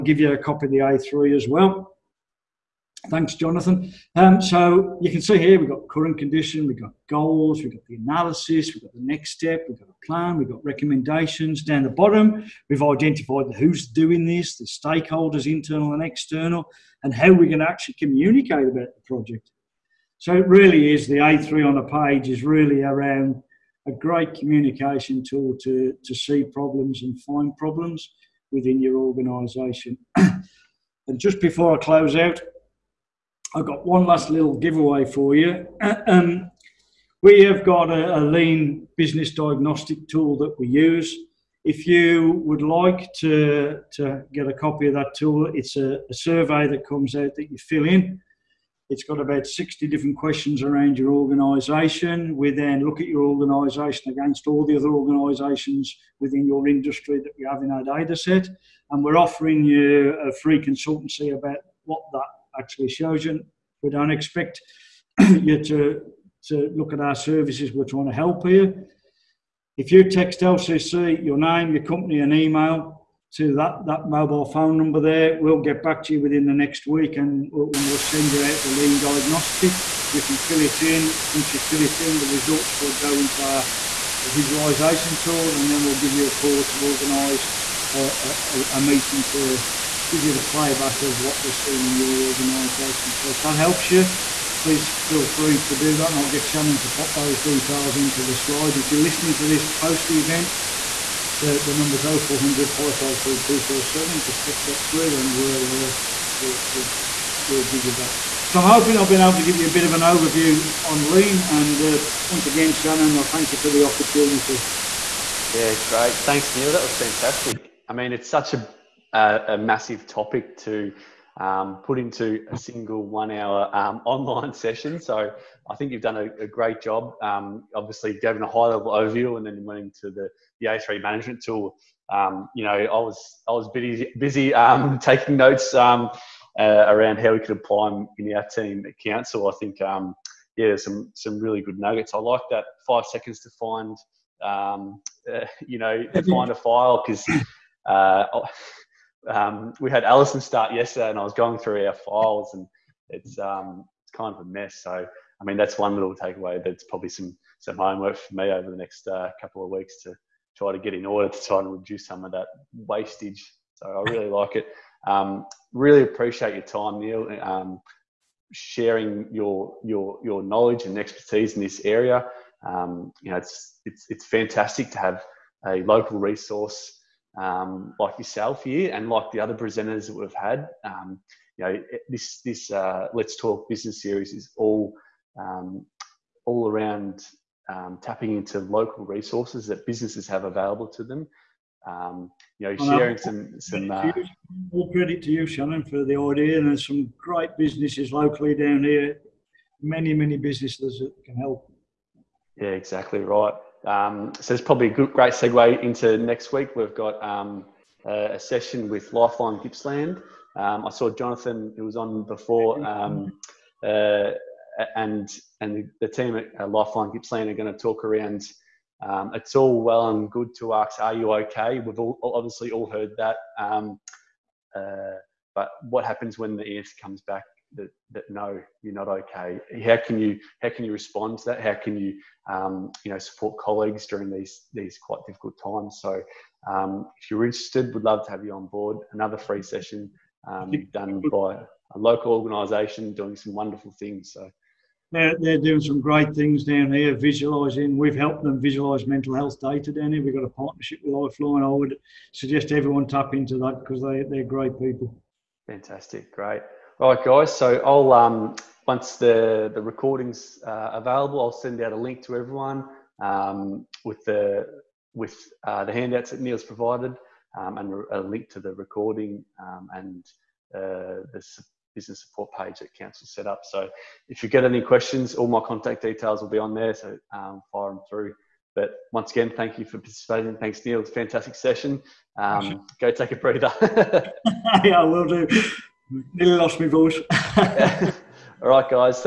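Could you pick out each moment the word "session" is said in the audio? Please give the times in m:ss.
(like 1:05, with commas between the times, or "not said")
2:04, 3:28, 3:59, 4:41.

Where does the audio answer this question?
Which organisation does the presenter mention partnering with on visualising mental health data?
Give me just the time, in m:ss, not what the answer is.
4:11.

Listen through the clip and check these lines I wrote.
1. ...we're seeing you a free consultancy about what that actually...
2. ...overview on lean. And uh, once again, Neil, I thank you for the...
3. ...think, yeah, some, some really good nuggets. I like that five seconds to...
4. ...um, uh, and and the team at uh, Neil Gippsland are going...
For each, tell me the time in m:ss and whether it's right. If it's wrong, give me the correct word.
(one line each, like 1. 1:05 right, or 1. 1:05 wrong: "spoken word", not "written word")
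1. 0:59 wrong: "offering", not "seeing"
2. 1:49 wrong: "Shannon", not "Neil"
3. 2:19 right
4. 3:32 wrong: "Lifeline", not "Neil".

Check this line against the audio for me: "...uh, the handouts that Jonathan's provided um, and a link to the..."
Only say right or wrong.
wrong.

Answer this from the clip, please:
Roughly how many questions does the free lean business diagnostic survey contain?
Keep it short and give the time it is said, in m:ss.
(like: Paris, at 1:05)
60, at 0:49.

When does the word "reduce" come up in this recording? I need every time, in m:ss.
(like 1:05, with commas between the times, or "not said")
2:41.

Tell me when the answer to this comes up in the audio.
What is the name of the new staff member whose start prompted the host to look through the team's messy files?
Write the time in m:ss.
2:30.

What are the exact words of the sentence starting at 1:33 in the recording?
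So if that helps you, please feel free to do that and I'll get Shannon to pop those details into the slide.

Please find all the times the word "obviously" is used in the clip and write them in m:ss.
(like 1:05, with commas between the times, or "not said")
2:07, 3:42.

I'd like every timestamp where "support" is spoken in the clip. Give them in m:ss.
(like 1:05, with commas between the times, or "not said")
3:53, 4:32.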